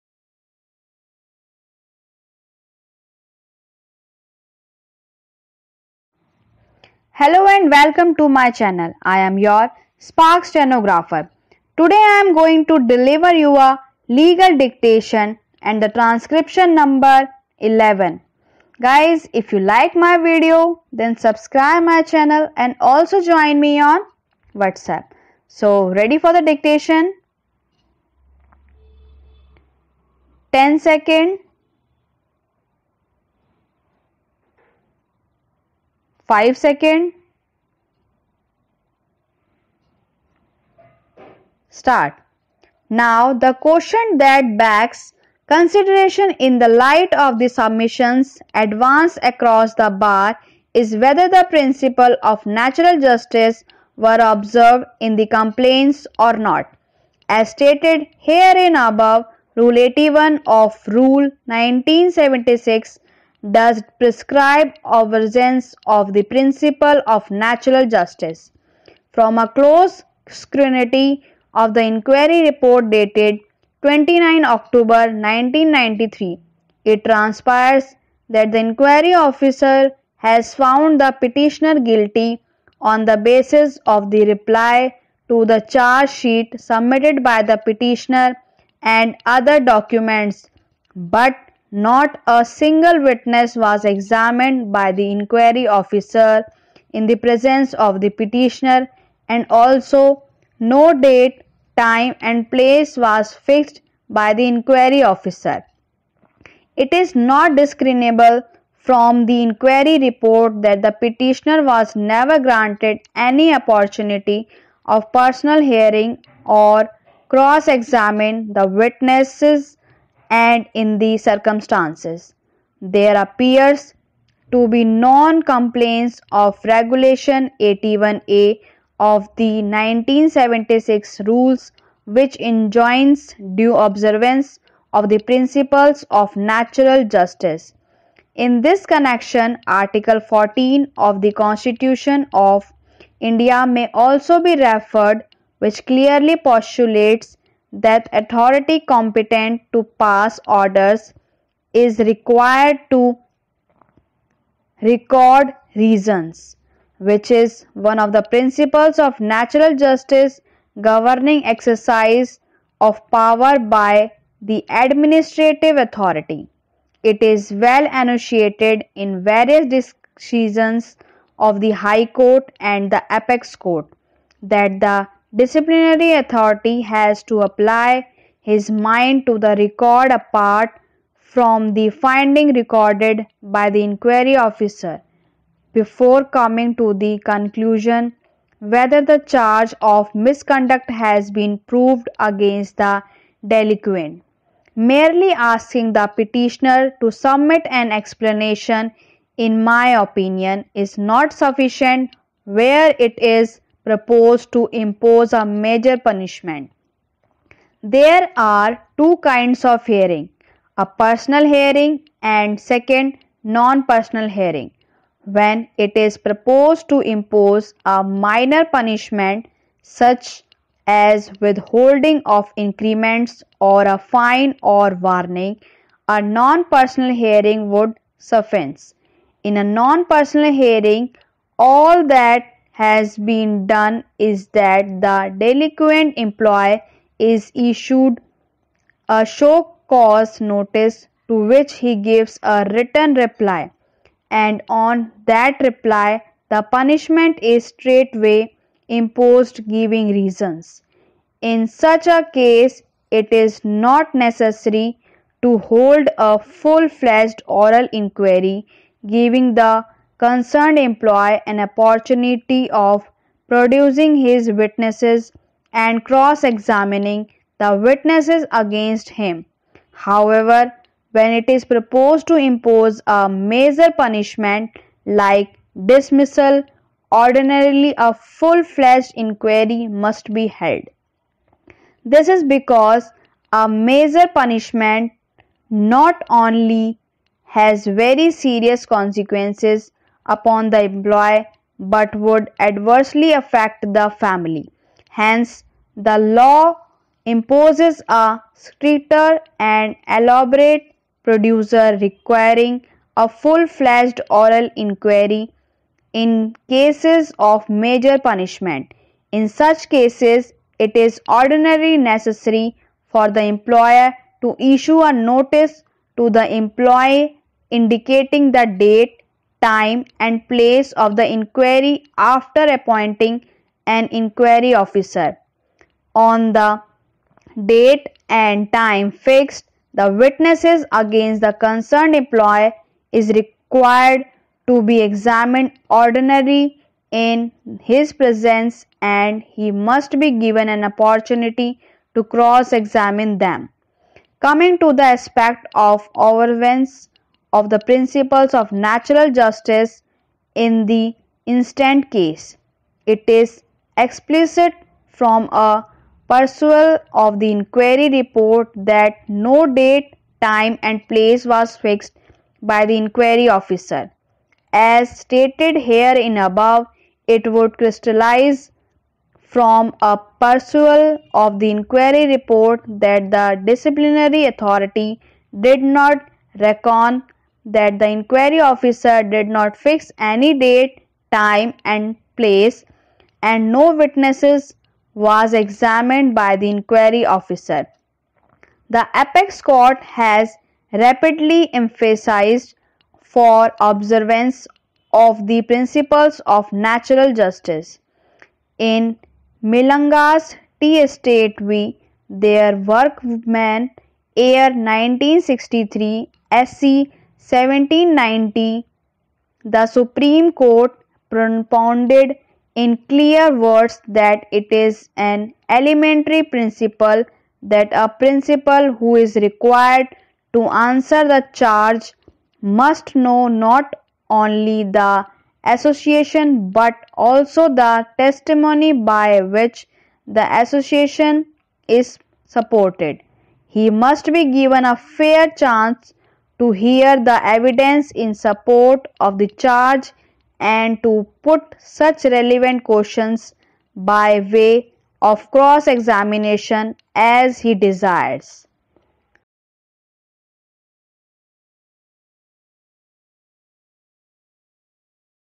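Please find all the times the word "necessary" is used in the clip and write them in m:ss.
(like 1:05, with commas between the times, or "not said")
4:14, 5:11.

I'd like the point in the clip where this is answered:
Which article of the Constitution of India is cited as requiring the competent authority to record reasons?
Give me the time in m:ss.
2:19.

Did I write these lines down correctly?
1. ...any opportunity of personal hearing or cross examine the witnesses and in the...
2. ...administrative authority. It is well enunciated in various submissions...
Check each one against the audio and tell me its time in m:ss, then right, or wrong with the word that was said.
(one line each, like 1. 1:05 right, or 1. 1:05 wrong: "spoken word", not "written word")
1. 1:53 right
2. 2:44 wrong: "decisions", not "submissions".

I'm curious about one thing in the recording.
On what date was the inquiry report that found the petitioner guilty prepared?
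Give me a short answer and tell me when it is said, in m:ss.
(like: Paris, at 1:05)
29 October 1993, at 1:13.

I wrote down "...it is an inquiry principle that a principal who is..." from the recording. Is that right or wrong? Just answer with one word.
wrong.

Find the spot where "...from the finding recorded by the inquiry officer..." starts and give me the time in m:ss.
3:01.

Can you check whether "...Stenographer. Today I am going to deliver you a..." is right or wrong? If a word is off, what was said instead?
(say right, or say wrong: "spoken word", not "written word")
right.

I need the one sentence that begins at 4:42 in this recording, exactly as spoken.
This is because a major punishment not only has very serious consequences upon the employee but would adversely affect the family.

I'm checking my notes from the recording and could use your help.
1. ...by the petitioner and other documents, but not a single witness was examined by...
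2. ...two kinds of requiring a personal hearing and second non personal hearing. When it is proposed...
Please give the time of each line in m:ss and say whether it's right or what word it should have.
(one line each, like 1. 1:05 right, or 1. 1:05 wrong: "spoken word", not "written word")
1. 1:27 right
2. 3:28 wrong: "hearing", not "requiring".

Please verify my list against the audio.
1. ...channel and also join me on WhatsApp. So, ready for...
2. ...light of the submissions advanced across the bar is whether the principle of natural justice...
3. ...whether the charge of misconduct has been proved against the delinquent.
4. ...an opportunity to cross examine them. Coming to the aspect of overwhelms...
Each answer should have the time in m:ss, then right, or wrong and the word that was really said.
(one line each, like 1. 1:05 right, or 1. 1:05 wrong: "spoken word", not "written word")
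1. 0:22 right
2. 0:46 right
3. 3:08 right
4. 5:40 right.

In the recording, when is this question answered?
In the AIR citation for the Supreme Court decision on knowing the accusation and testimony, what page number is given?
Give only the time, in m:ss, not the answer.
6:47.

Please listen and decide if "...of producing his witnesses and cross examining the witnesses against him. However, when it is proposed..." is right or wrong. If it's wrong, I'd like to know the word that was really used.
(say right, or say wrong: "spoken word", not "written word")
right.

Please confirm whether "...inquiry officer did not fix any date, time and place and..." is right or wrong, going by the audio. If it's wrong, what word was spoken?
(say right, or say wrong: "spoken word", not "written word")
right.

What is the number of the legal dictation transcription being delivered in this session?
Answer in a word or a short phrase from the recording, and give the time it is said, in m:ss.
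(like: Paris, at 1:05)
11, at 0:17.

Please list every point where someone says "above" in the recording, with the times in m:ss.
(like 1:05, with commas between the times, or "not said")
0:58, 6:06.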